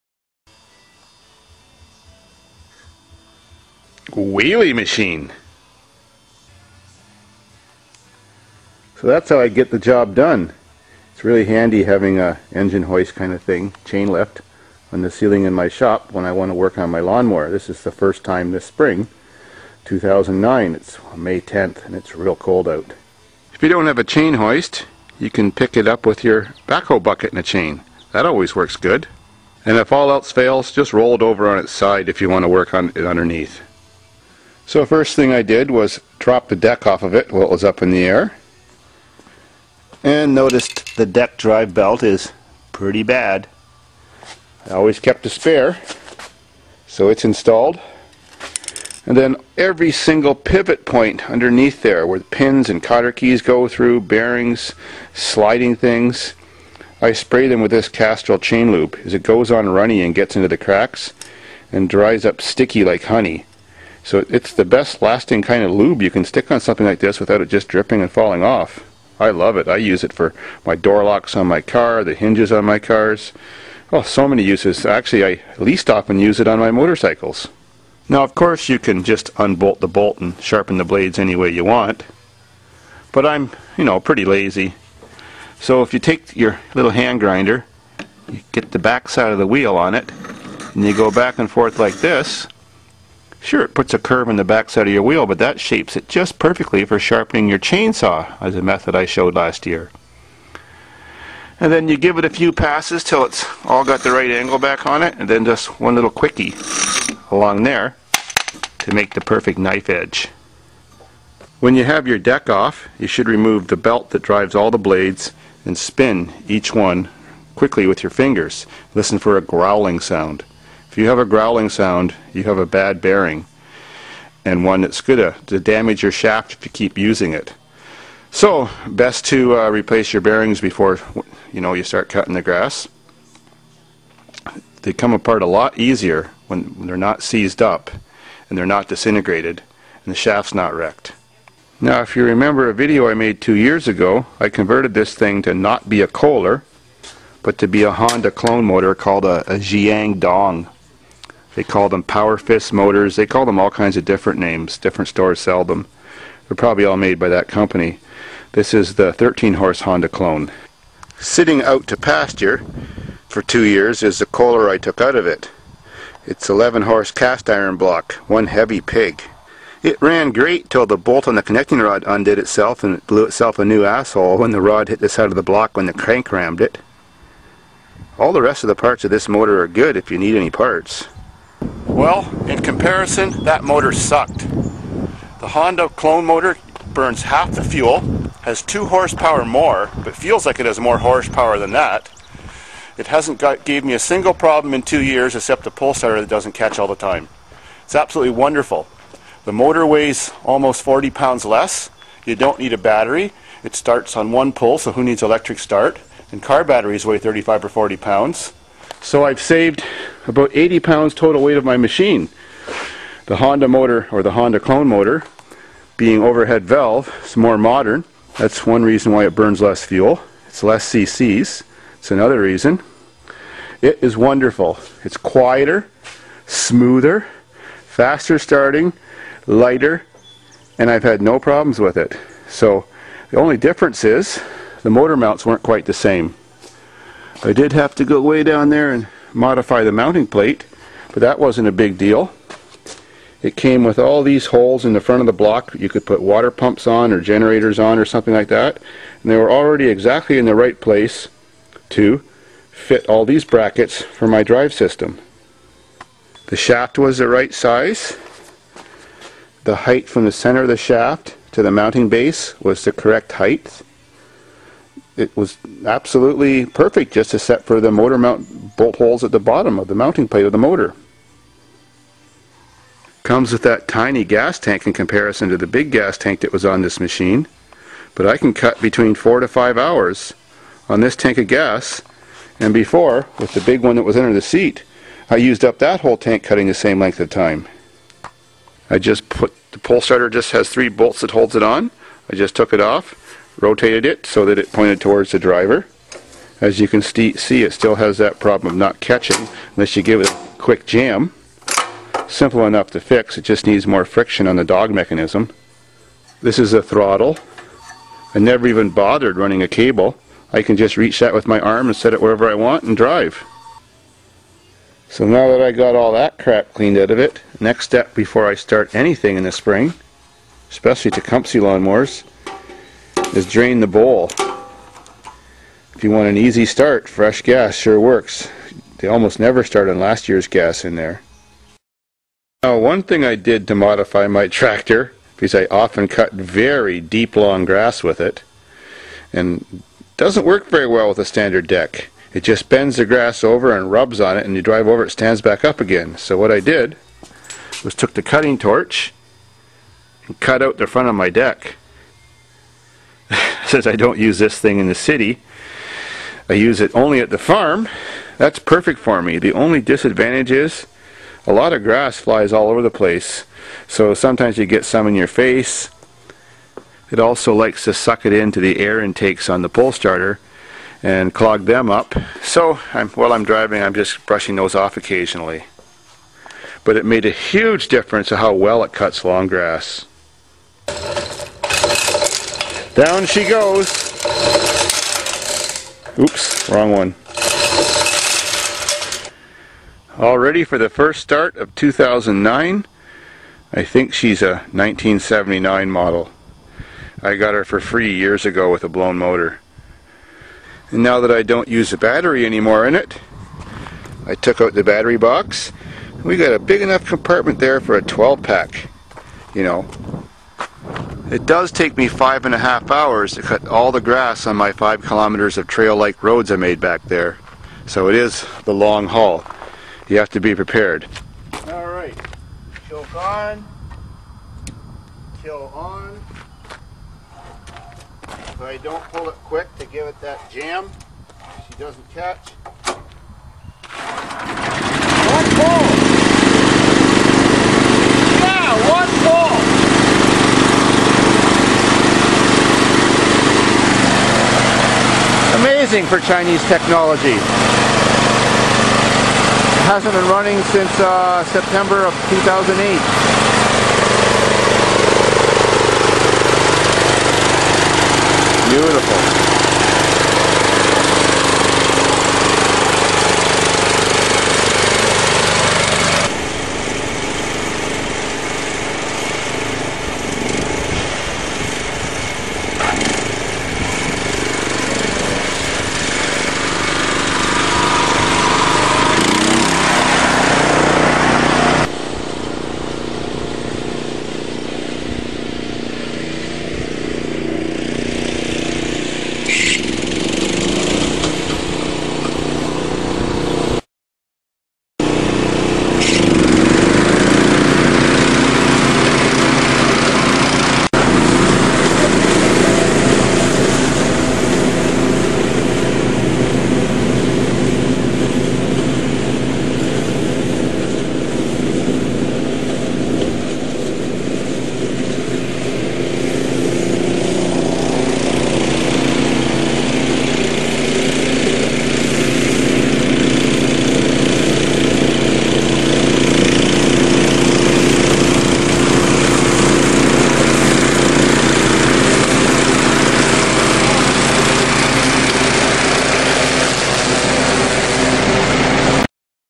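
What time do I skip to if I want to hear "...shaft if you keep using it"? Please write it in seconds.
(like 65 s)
126 s.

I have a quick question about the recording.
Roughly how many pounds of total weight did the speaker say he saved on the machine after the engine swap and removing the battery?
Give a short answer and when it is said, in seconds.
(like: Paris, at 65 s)
80, at 210 s.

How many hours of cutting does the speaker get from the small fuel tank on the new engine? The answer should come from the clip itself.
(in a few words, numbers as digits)
4 to 5.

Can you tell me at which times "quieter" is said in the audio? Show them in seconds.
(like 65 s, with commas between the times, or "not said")
225 s.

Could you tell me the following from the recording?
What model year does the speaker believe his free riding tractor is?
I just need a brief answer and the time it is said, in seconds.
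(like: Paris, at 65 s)
1979, at 394 s.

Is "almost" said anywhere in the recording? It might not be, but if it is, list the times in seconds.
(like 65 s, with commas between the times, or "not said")
200 s, 329 s.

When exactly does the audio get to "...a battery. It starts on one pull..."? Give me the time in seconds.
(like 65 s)
202 s.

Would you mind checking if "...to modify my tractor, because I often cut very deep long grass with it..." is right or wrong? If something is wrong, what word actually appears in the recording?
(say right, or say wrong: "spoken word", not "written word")
right.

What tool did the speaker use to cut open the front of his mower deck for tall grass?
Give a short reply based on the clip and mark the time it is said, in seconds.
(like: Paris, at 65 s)
cutting torch, at 348 s.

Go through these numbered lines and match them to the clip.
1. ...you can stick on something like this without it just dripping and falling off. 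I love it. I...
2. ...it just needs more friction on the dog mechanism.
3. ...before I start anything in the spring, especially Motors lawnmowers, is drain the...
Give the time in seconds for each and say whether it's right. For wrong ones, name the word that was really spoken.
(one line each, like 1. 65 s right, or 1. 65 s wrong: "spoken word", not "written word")
1. 66 s right
2. 303 s right
3. 318 s wrong: "Tecumseh", not "Motors".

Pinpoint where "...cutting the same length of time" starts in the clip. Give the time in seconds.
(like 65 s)
286 s.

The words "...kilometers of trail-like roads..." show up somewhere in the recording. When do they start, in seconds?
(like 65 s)
415 s.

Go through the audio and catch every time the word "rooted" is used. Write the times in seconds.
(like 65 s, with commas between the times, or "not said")
not said.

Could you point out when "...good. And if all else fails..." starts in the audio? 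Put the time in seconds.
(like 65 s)
28 s.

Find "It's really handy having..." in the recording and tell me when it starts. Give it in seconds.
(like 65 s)
11 s.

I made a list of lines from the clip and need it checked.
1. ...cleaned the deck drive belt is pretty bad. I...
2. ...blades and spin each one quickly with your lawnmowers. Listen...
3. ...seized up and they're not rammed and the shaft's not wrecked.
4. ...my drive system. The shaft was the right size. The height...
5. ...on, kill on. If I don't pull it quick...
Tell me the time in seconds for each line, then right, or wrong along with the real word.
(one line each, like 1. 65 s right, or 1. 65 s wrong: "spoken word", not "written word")
1. 40 s wrong: "noticed", not "cleaned"
2. 114 s wrong: "fingers", not "lawnmowers"
3. 137 s wrong: "disintegrated", not "rammed"
4. 254 s right
5. 423 s right.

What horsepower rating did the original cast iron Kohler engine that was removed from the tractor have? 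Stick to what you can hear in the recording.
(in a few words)
11.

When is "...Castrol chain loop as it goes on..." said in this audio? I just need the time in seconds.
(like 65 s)
57 s.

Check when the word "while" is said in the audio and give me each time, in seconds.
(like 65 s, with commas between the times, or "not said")
37 s, 373 s.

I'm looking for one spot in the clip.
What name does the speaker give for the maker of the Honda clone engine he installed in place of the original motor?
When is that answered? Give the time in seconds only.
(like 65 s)
149 s.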